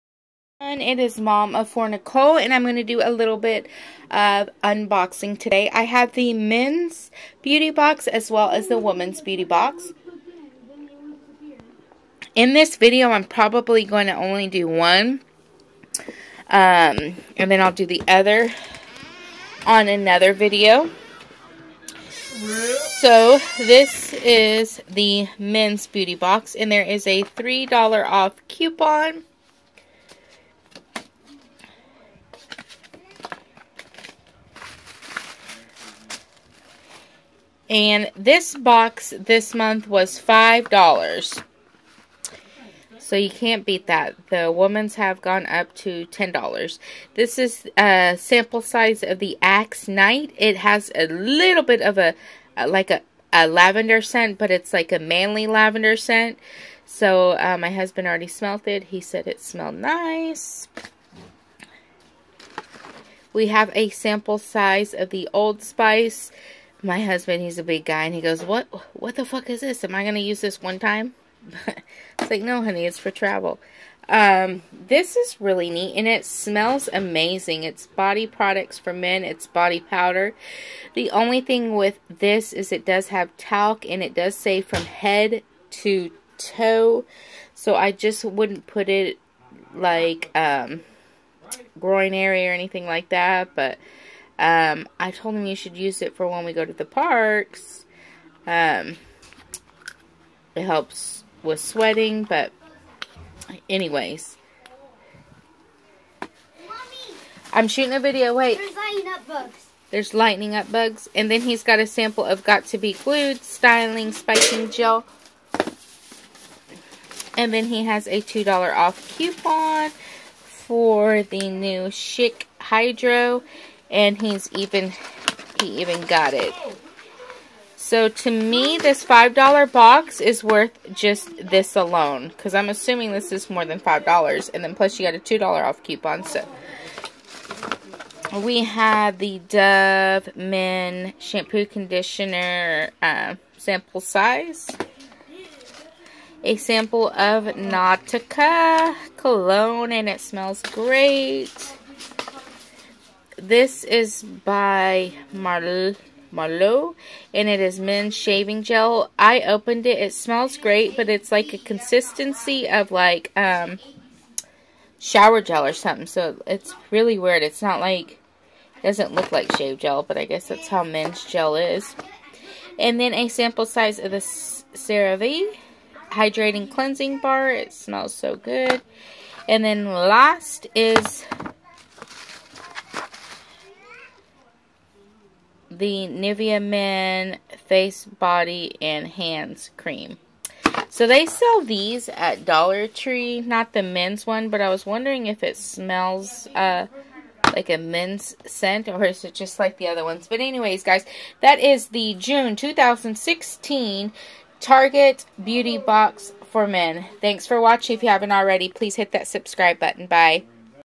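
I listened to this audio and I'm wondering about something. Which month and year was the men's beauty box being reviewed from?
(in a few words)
June 2016.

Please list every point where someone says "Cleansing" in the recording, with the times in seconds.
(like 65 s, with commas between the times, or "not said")
176 s.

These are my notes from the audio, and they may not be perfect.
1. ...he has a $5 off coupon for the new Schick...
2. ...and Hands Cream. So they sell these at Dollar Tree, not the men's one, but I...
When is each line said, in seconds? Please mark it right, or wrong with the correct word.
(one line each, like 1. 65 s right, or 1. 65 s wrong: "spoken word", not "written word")
1. 117 s wrong: "2", not "5"
2. 188 s right.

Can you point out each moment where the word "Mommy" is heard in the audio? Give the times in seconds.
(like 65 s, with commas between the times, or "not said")
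106 s.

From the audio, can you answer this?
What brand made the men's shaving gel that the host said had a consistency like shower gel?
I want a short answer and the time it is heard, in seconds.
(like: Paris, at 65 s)
Marlowe, at 156 s.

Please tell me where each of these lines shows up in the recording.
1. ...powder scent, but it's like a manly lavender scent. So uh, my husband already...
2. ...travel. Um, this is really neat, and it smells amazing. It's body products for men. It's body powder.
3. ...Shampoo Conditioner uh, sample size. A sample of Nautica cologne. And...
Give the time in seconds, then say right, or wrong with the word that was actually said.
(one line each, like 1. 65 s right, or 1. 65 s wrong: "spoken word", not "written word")
1. 53 s wrong: "lavender", not "powder"
2. 73 s right
3. 141 s right.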